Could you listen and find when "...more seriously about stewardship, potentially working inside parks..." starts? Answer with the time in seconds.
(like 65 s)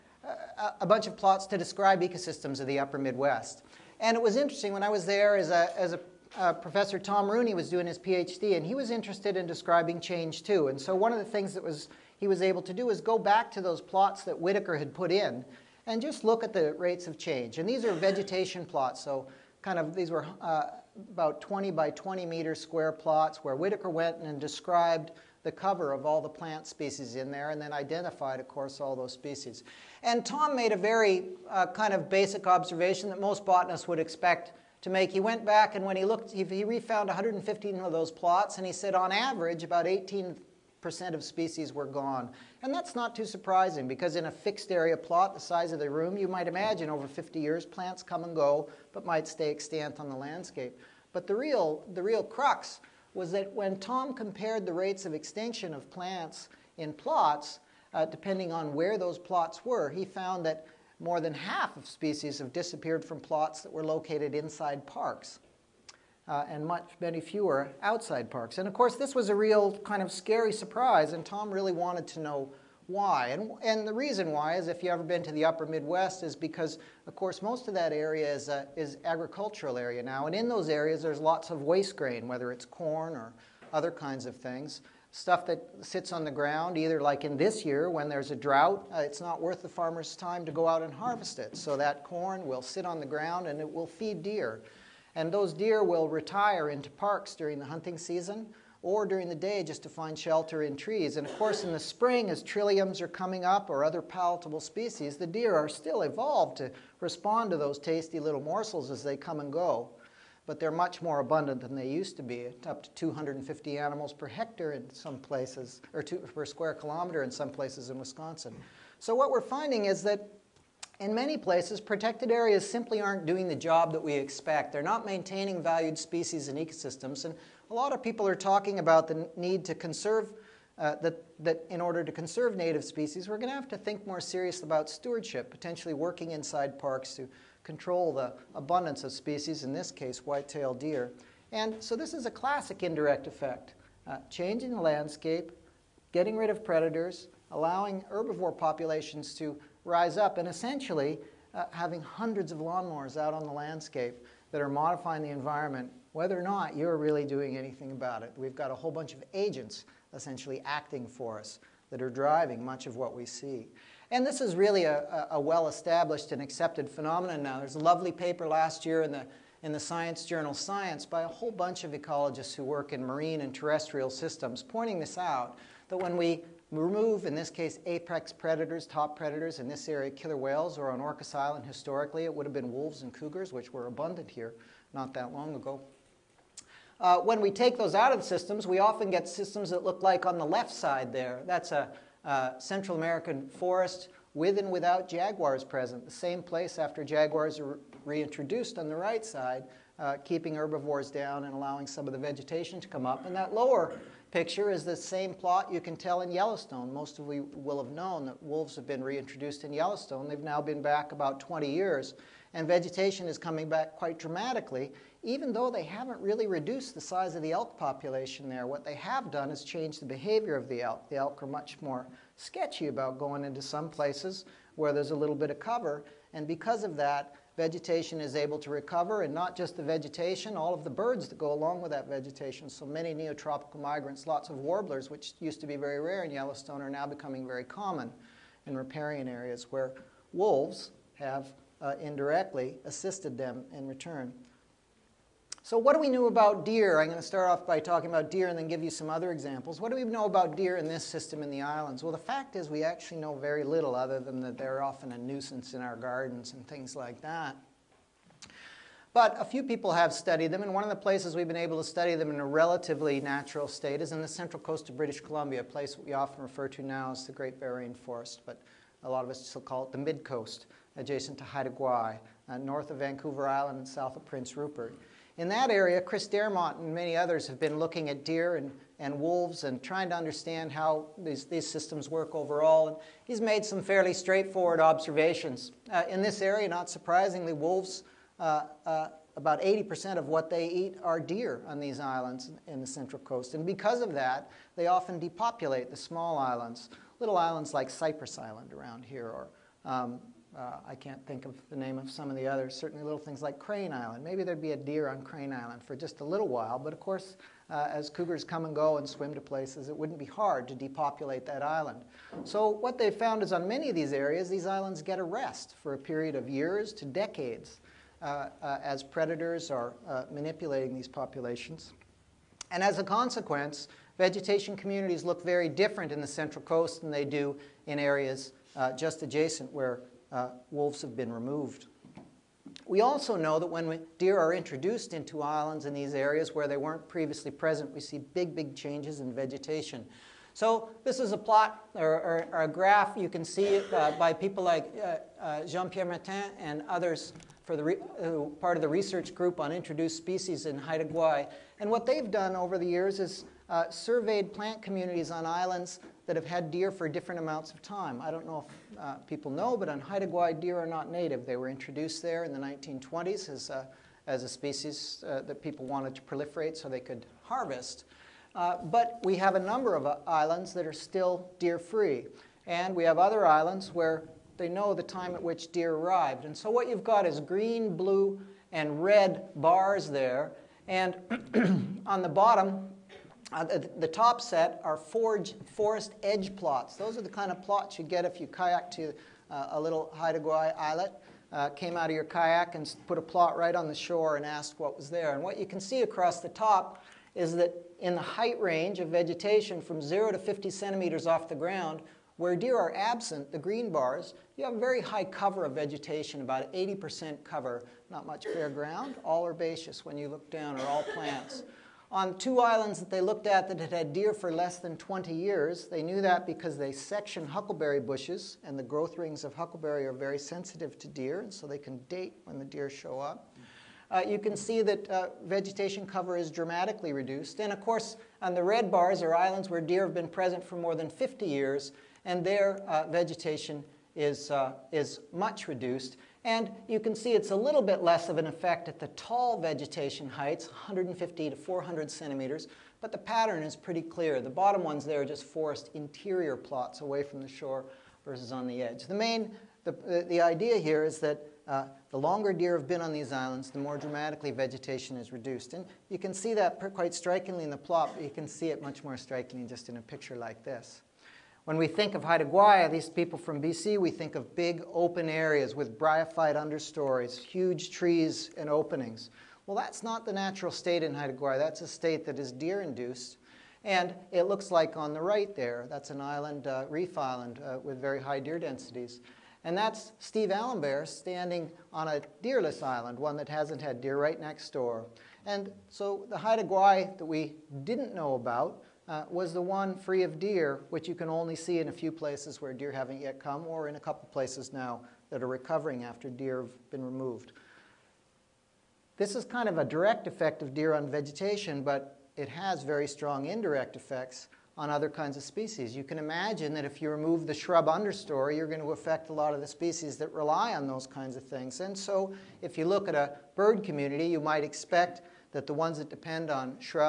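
134 s.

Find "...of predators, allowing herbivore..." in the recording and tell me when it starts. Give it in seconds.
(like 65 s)
146 s.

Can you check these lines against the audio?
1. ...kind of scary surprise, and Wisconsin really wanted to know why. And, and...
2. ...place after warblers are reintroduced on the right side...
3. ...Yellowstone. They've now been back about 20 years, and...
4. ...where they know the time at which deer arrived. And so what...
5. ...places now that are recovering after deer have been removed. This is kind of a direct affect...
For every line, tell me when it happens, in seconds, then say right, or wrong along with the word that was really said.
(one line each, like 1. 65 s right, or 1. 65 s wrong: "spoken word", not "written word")
1. 69 s wrong: "Tom", not "Wisconsin"
2. 196 s wrong: "jaguars", not "warblers"
3. 209 s right
4. 373 s right
5. 494 s wrong: "effect", not "affect".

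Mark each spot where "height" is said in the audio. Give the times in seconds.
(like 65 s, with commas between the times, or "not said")
398 s, 440 s.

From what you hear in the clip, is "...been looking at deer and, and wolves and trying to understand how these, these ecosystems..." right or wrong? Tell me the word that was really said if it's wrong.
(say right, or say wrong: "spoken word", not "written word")
wrong: "systems", not "ecosystems".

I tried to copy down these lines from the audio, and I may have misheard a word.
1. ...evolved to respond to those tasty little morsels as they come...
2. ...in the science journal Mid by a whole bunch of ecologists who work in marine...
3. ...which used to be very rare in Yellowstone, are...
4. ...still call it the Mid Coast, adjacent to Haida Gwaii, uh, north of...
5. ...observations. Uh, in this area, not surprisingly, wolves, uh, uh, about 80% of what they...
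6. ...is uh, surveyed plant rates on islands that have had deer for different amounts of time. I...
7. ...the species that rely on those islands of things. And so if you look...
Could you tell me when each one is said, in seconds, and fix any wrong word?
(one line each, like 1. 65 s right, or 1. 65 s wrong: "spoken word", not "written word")
1. 106 s right
2. 169 s wrong: "Science", not "Mid"
3. 235 s right
4. 269 s right
5. 284 s right
6. 353 s wrong: "communities", not "rates"
7. 509 s wrong: "kinds", not "islands".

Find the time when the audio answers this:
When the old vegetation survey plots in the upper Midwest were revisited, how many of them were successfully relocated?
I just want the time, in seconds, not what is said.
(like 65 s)
37 s.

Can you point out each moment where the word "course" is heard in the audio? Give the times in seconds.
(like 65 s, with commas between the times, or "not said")
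28 s, 68 s, 77 s, 101 s, 307 s, 427 s.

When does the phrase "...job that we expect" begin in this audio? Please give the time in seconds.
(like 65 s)
123 s.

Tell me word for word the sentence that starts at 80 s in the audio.
And in those areas, there's lots of waste grain, whether it's corn or other kinds of things.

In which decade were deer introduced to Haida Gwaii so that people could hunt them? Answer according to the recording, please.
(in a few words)
1920s.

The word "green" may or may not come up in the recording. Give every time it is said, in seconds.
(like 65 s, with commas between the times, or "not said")
377 s, 403 s.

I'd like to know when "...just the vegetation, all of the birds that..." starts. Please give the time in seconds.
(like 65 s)
229 s.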